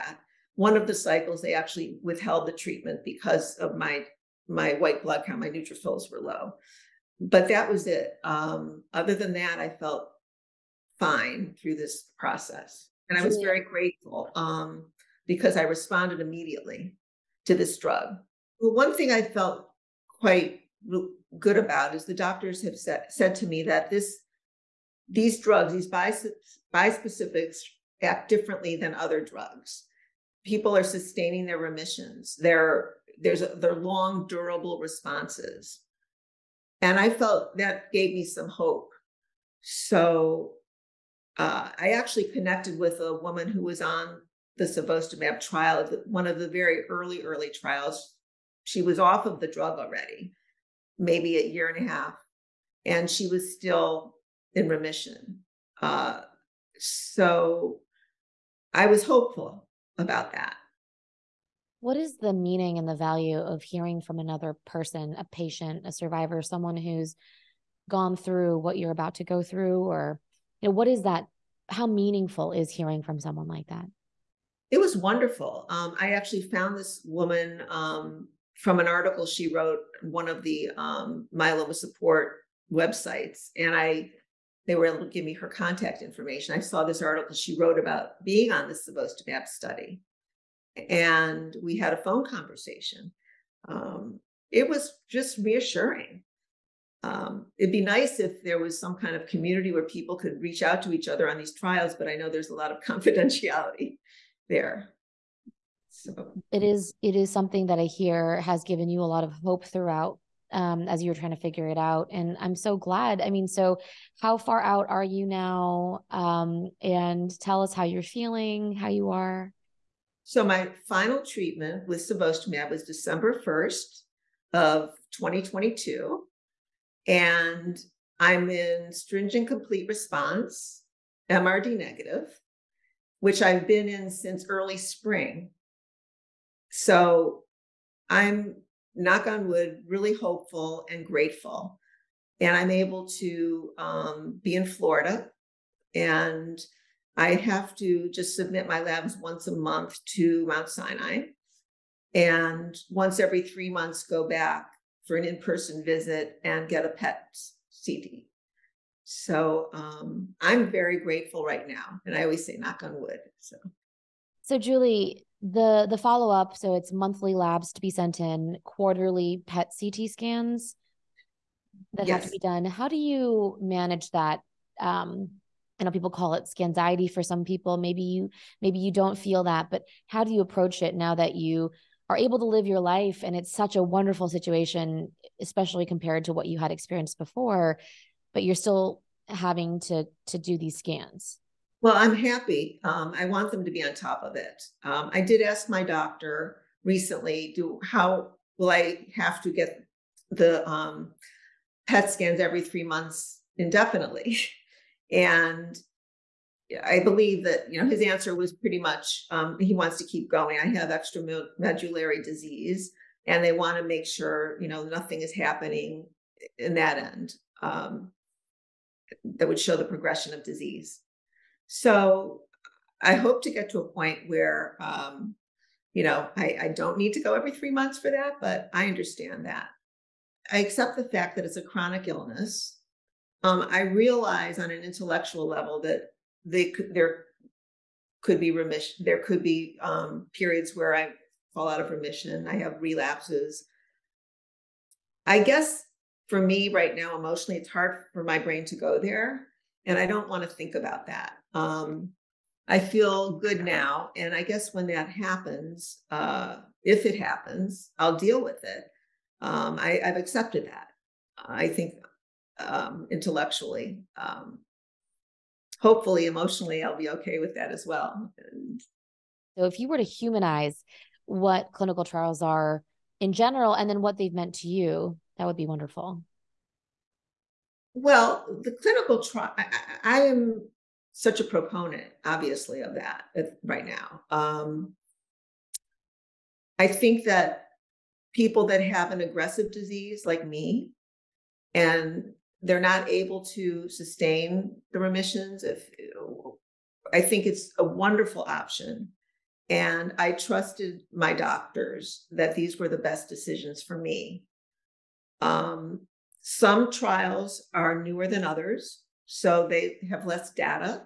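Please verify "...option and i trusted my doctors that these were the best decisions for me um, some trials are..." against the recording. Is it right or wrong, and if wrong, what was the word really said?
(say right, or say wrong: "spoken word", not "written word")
right.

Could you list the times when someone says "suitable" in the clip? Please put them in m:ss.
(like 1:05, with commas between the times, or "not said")
not said.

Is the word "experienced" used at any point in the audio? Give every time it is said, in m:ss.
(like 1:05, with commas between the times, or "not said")
3:06.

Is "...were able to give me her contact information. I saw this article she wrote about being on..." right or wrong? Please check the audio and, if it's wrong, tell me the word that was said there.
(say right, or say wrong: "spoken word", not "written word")
right.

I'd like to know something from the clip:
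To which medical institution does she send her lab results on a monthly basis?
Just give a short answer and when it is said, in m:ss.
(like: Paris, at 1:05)
Mount Sinai, at 2:30.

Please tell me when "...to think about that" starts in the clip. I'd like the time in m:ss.
4:10.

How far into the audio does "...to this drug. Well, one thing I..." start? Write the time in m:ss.
0:17.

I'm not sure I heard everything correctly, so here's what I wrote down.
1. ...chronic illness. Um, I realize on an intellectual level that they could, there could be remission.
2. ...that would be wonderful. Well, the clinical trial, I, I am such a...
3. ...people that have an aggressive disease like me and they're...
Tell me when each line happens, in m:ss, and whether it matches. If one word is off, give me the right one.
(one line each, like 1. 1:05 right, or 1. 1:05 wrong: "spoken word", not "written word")
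1. 3:51 right
2. 4:35 right
3. 4:48 right.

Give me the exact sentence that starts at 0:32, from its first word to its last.
They're there's a, they're long durable responses, and I felt that gave me some hope.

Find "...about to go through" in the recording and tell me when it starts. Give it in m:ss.
1:08.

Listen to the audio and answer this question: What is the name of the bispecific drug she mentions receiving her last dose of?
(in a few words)
Cevostamab.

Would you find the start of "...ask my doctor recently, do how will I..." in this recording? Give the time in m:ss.
3:15.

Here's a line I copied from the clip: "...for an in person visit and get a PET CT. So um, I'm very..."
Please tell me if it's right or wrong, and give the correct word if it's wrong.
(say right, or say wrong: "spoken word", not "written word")
right.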